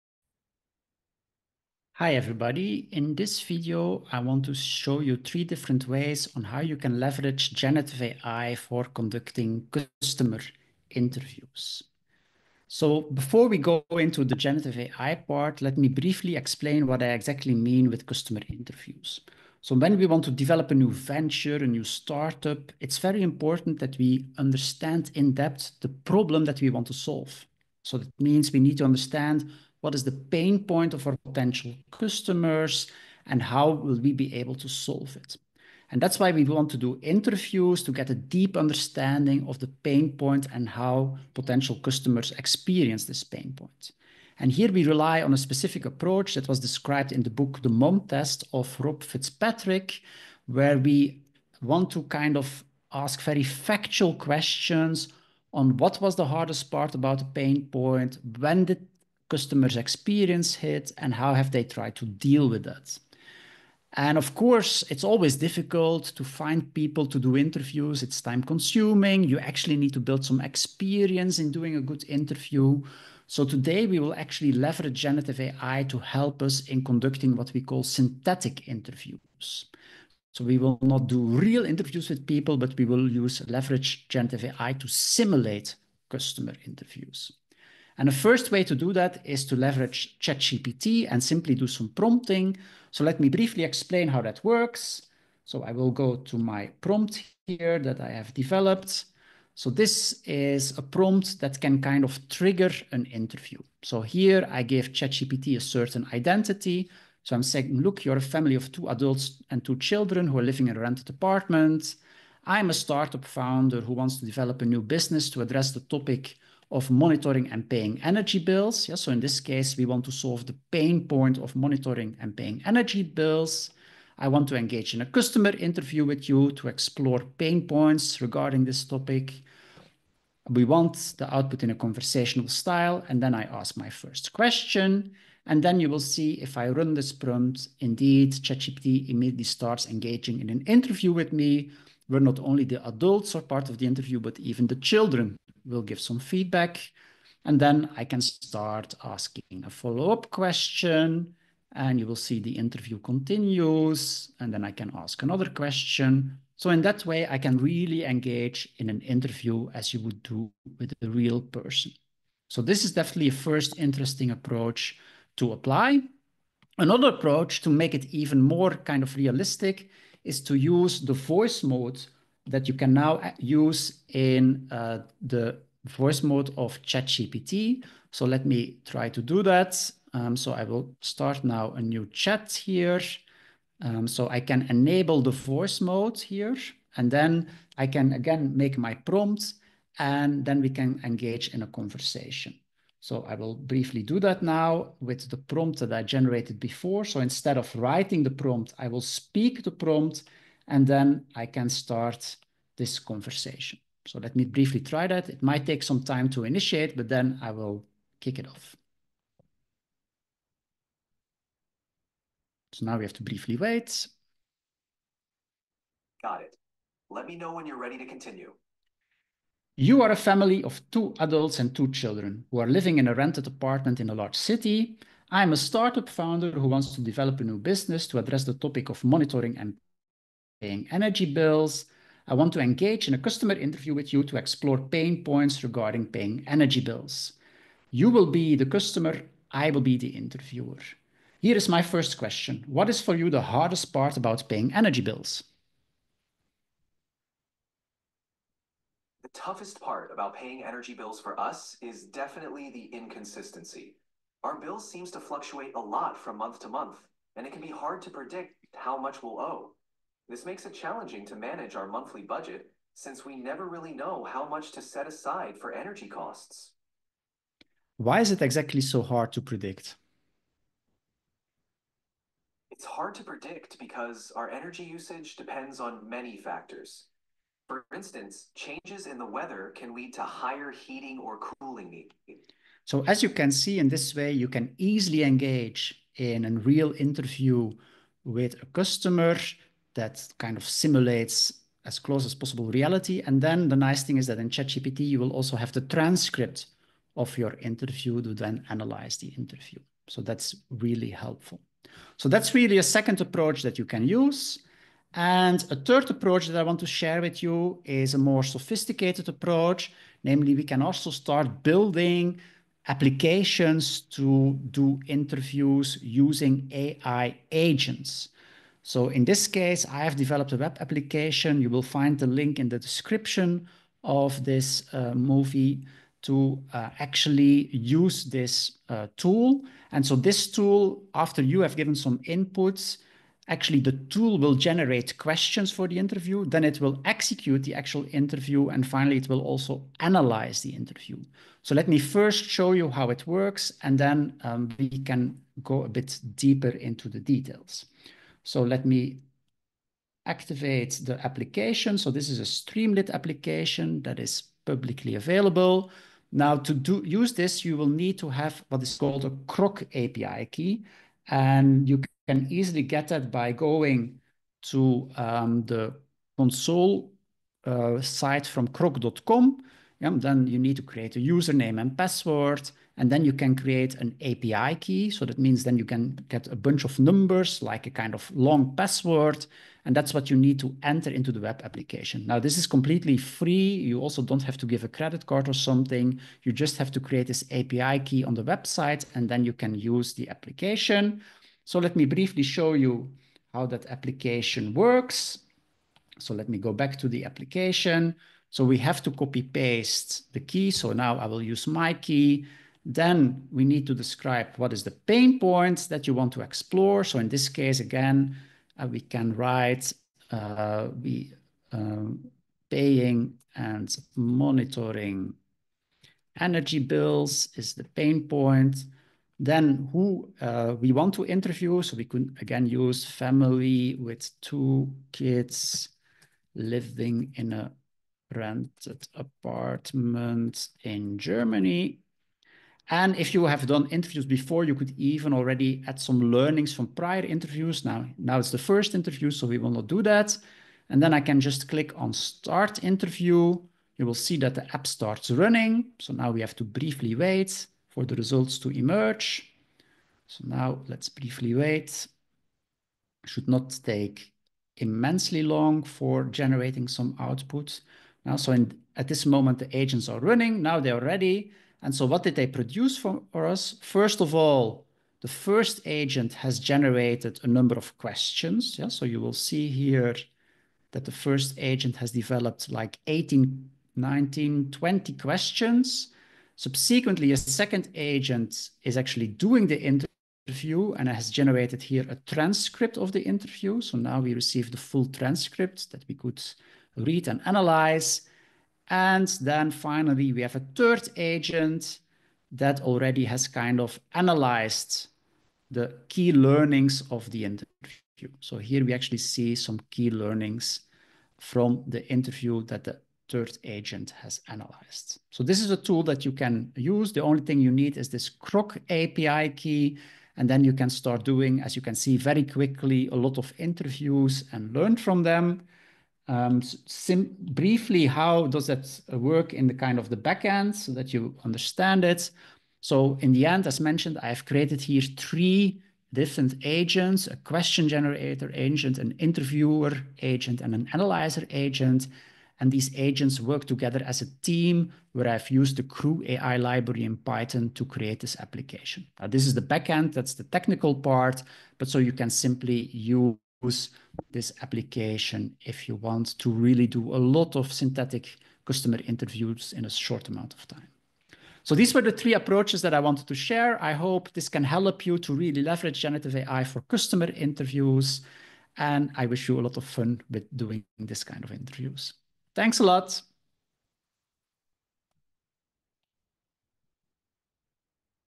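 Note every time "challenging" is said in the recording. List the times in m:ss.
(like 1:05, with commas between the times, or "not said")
4:20.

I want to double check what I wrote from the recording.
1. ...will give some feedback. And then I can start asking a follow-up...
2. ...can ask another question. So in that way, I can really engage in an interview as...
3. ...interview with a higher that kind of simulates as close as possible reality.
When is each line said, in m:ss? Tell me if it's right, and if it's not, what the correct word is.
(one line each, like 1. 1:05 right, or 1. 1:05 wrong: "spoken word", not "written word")
1. 2:25 right
2. 2:34 right
3. 4:46 wrong: "customer", not "higher".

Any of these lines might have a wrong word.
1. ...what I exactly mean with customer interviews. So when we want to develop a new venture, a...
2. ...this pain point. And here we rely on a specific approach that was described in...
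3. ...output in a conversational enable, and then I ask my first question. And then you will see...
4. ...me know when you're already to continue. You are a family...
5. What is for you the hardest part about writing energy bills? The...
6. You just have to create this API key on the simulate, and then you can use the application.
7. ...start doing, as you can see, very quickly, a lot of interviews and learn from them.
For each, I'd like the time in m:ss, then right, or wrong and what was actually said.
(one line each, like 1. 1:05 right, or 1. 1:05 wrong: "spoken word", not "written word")
1. 0:16 right
2. 0:43 right
3. 2:11 wrong: "style", not "enable"
4. 3:37 wrong: "ready", not "already"
5. 4:02 wrong: "paying", not "writing"
6. 6:26 wrong: "website", not "simulate"
7. 8:30 right.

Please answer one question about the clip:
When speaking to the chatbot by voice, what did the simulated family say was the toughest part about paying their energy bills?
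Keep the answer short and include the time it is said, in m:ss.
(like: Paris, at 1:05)
inconsistency, at 4:12.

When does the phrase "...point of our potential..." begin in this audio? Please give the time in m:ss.
0:30.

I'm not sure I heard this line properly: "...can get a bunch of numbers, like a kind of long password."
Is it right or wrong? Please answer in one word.
right.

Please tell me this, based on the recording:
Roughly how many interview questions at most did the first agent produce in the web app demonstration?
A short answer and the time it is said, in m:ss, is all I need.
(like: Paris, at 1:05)
20, at 7:54.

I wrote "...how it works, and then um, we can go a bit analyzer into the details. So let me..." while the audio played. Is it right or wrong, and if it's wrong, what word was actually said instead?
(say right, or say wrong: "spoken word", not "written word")
wrong: "deeper", not "analyzer".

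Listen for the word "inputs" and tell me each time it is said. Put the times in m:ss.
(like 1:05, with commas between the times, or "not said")
5:32.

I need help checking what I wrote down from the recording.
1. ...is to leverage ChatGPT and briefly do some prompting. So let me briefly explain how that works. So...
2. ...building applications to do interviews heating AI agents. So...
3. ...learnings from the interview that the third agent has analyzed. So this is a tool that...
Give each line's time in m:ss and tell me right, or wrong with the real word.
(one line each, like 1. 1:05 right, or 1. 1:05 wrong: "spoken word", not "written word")
1. 1:29 wrong: "simply", not "briefly"
2. 5:11 wrong: "using", not "heating"
3. 8:20 right.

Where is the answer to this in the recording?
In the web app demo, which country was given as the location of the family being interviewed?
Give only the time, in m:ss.
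7:11.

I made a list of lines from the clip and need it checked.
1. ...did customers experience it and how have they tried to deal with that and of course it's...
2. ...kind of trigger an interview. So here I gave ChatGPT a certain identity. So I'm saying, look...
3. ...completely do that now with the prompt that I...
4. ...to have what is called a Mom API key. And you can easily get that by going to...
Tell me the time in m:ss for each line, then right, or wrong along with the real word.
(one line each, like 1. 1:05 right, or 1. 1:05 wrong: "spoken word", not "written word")
1. 0:58 right
2. 1:41 right
3. 3:13 wrong: "briefly", not "completely"
4. 5:58 wrong: "Groq", not "Mom".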